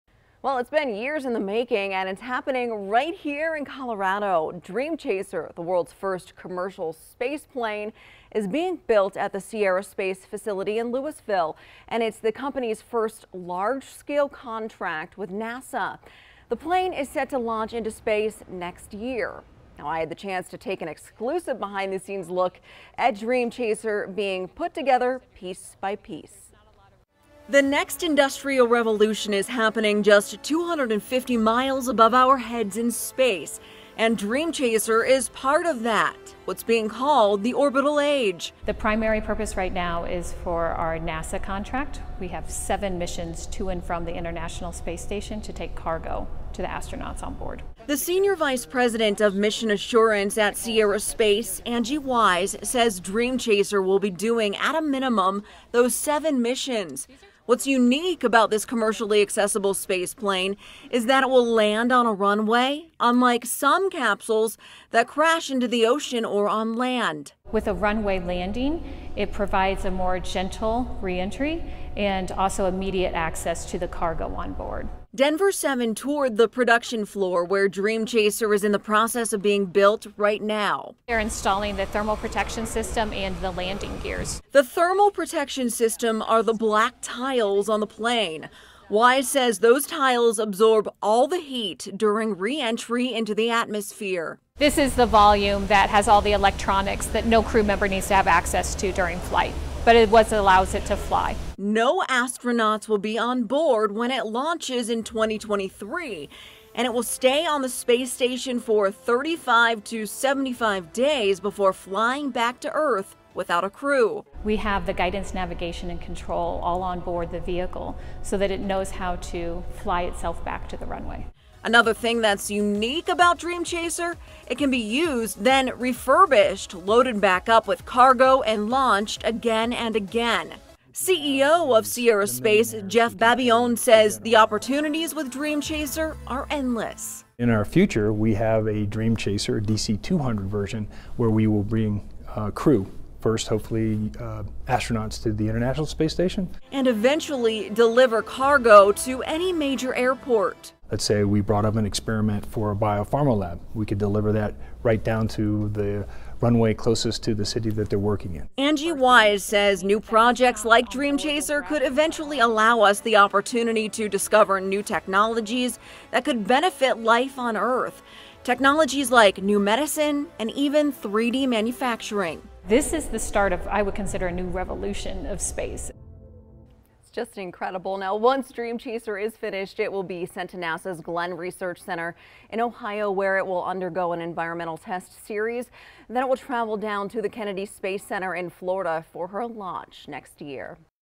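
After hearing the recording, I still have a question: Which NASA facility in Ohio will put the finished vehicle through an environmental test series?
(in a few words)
Glenn Research Center.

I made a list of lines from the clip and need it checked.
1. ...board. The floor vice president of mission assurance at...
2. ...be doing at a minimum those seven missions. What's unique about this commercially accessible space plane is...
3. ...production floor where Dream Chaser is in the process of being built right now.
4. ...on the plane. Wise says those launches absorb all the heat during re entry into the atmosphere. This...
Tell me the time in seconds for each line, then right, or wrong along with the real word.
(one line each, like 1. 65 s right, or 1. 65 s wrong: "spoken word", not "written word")
1. 47 s wrong: "senior", not "floor"
2. 53 s right
3. 76 s right
4. 87 s wrong: "tiles", not "launches".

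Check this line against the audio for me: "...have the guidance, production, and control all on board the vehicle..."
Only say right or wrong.
wrong.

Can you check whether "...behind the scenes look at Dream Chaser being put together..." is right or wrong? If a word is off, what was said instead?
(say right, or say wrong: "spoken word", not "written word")
right.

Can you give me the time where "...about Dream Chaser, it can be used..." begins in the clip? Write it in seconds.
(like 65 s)
123 s.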